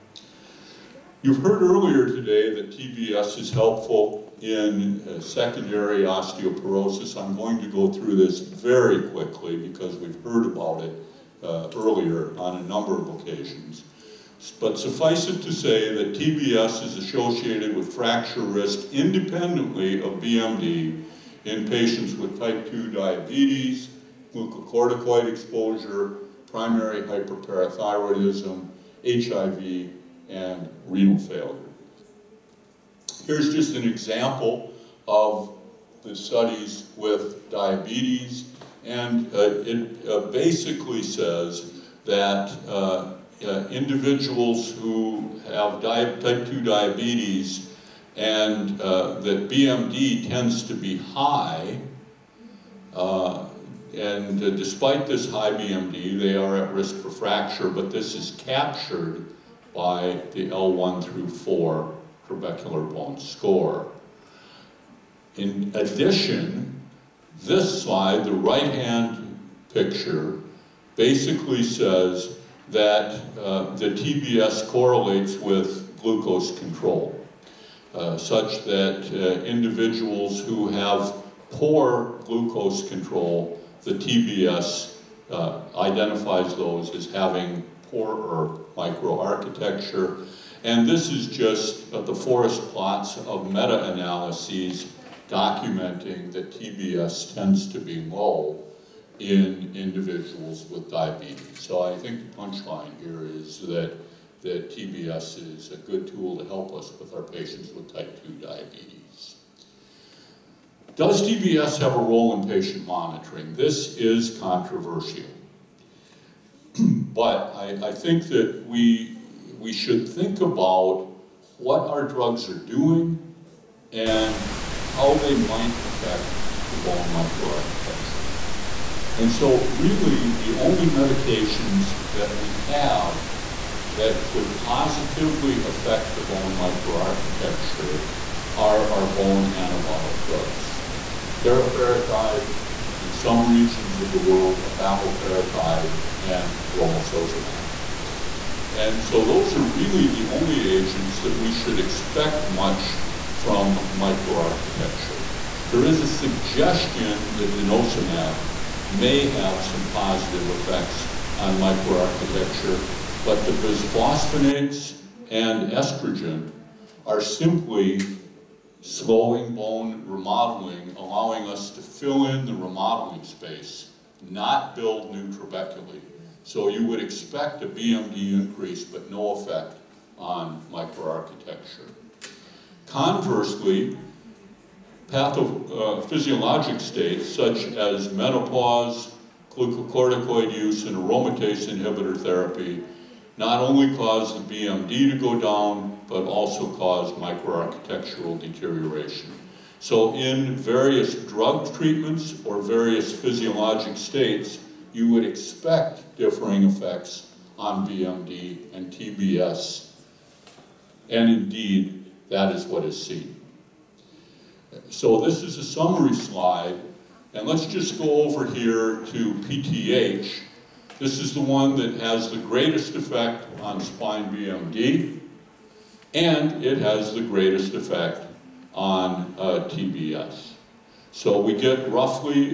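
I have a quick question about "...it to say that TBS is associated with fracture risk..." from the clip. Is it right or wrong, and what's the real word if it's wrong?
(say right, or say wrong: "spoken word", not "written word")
right.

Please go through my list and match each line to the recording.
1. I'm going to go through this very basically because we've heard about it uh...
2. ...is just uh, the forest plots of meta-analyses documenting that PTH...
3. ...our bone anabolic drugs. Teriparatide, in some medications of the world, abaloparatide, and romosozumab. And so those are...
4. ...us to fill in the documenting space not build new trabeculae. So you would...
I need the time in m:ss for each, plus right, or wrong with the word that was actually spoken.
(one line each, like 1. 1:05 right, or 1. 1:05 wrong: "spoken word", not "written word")
1. 0:07 wrong: "quickly", not "basically"
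2. 1:31 wrong: "TBS", not "PTH"
3. 2:18 wrong: "regions", not "medications"
4. 2:51 wrong: "remodeling", not "documenting".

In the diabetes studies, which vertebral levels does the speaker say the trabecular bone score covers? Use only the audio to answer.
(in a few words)
L1 through 4.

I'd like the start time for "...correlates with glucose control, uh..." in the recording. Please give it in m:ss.
1:14.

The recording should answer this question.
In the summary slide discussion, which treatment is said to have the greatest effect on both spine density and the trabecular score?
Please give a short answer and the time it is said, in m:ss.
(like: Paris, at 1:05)
PTH, at 3:39.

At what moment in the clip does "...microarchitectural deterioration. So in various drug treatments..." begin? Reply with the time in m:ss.
3:17.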